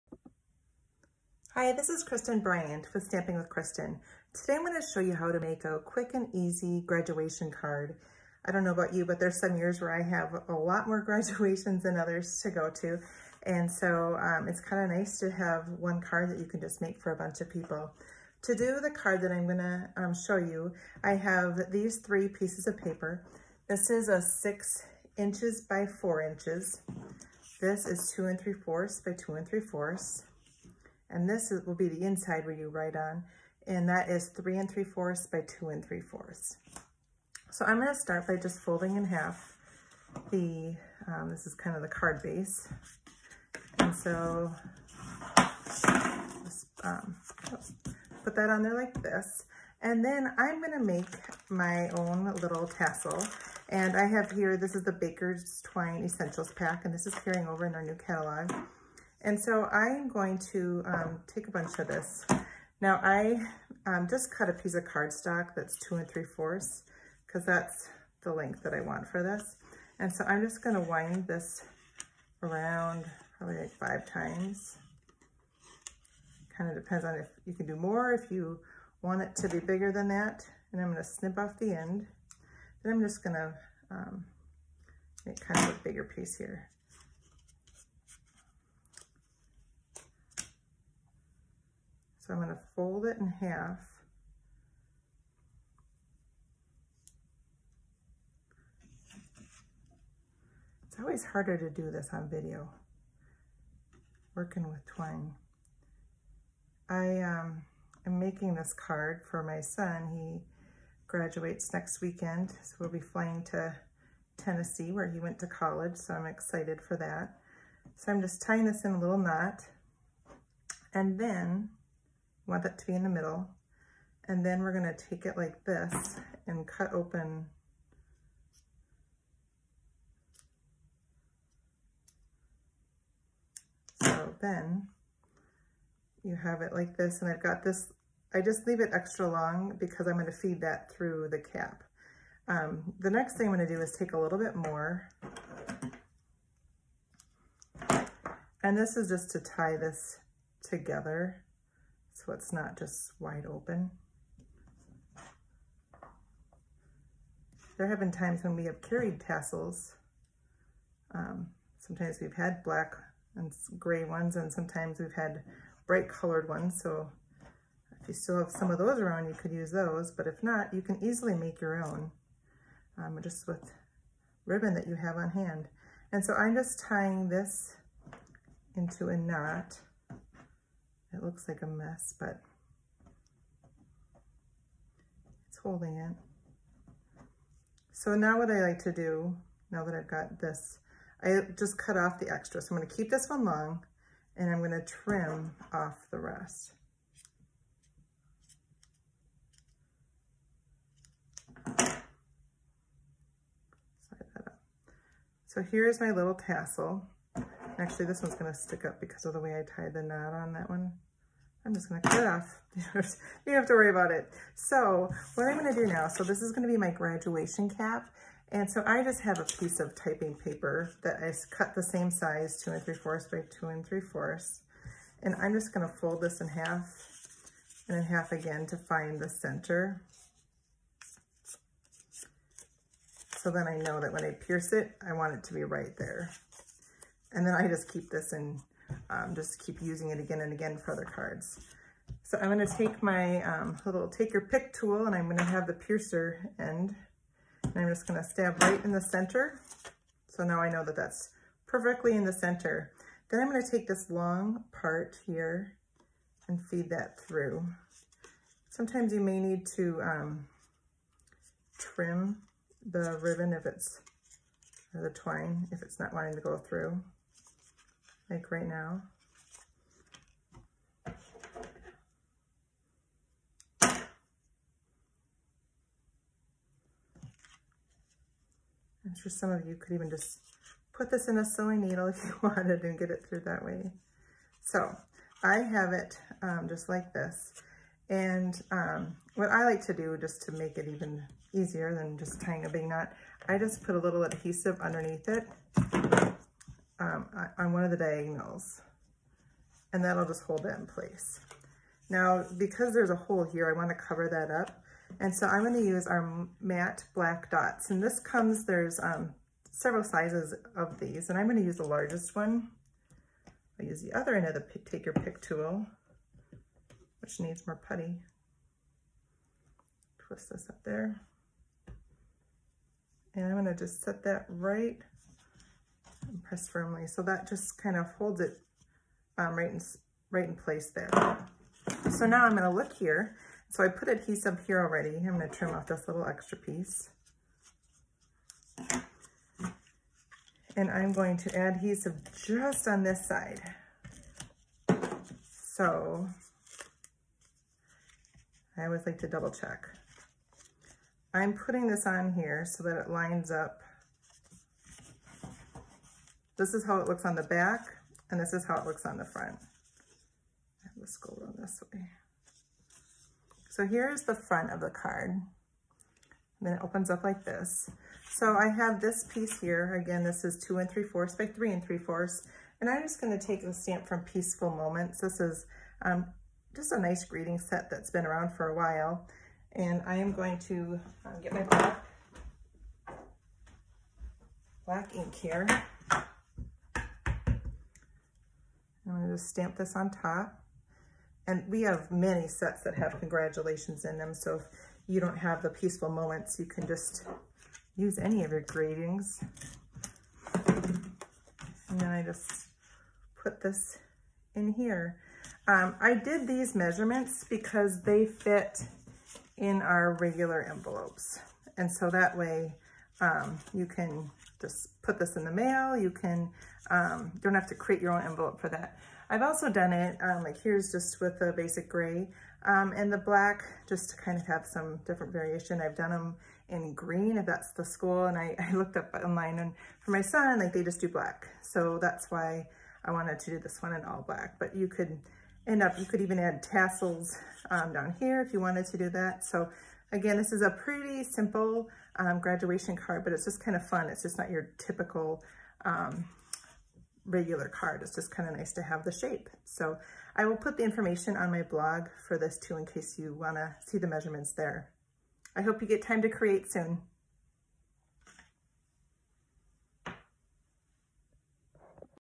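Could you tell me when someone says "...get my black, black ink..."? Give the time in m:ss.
6:21.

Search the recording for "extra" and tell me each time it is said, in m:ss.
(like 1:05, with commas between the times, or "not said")
2:18, 3:12, 5:36.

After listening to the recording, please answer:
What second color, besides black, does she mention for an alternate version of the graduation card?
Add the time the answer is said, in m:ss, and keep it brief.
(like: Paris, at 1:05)
basic gray, at 7:01.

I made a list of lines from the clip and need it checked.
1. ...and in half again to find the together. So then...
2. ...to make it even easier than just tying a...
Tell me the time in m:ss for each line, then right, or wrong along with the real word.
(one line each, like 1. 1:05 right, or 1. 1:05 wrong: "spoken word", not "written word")
1. 3:47 wrong: "center", not "together"
2. 4:50 right.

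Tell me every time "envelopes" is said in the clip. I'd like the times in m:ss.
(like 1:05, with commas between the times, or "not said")
6:50, 6:58.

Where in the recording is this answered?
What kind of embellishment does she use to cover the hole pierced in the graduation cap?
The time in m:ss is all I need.
5:06.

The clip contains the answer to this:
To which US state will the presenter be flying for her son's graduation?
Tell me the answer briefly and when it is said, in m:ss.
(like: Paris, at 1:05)
Tennessee, at 1:54.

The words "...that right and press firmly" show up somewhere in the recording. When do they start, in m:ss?
5:24.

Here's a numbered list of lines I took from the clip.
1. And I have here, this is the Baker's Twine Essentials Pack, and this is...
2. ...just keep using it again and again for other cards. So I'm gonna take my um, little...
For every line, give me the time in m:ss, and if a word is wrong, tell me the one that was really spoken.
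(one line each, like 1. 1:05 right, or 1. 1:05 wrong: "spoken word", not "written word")
1. 0:53 right
2. 3:59 right.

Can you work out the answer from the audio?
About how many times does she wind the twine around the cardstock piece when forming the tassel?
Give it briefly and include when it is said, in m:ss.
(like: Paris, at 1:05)
5, at 1:13.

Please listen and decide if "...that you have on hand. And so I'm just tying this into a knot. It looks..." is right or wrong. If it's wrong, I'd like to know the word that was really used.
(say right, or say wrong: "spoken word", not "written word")
right.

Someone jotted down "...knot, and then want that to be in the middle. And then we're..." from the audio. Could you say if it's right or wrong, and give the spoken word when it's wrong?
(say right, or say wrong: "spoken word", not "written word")
right.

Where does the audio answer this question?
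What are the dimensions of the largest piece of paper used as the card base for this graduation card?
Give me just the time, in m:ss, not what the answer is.
0:24.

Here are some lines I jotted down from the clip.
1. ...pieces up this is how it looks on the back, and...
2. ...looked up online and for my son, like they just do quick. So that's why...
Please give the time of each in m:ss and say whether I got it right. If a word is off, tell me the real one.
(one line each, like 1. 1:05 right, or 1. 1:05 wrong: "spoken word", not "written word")
1. 5:53 wrong: "lines", not "pieces"
2. 7:08 wrong: "black", not "quick".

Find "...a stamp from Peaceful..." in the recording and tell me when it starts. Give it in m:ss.
6:13.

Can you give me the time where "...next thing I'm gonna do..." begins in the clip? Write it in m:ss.
2:23.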